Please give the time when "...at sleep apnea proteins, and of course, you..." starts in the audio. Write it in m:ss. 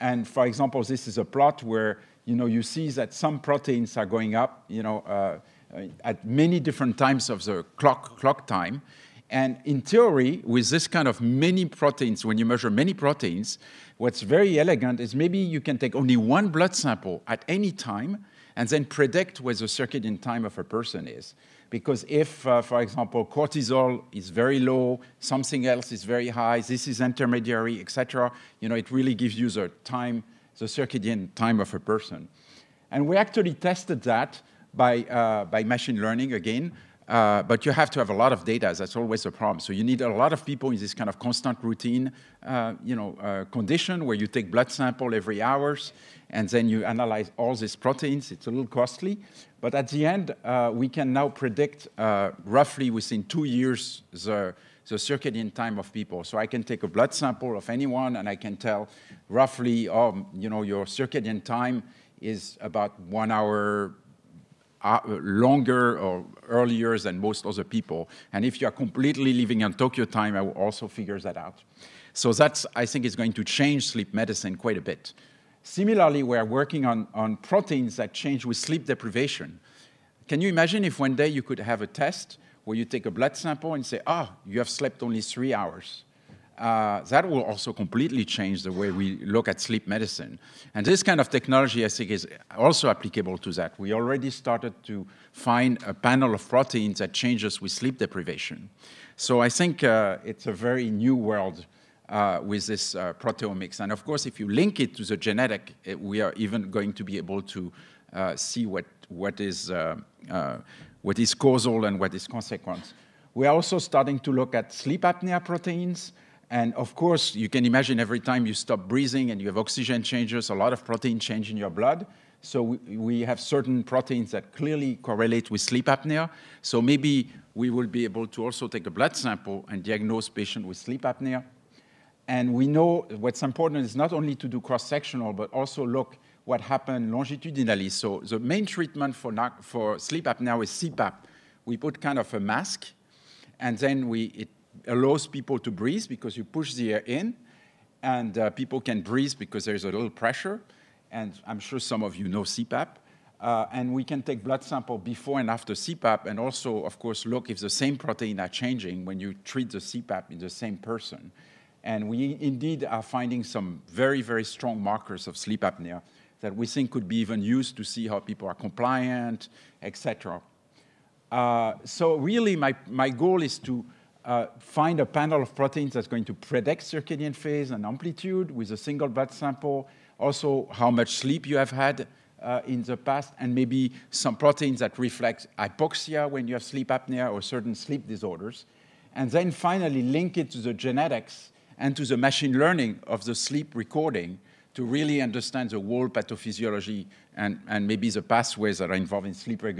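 1:54.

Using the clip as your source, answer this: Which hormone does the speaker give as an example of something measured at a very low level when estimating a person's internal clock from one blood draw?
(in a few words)
cortisol.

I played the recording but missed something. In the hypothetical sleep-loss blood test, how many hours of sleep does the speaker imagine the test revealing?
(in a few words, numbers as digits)
3 hours.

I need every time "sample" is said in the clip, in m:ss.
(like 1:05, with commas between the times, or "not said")
0:16, 0:44, 0:57, 1:23, 2:09, 2:34, 2:59.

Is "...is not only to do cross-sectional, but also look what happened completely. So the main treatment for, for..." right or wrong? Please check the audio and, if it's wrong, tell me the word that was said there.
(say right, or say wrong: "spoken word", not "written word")
wrong: "longitudinally", not "completely".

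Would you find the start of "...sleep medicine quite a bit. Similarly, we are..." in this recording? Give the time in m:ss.
1:13.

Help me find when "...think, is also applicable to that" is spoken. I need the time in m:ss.
1:31.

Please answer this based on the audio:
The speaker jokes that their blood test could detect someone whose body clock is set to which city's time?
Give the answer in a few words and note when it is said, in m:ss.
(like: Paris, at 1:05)
Tokyo, at 1:09.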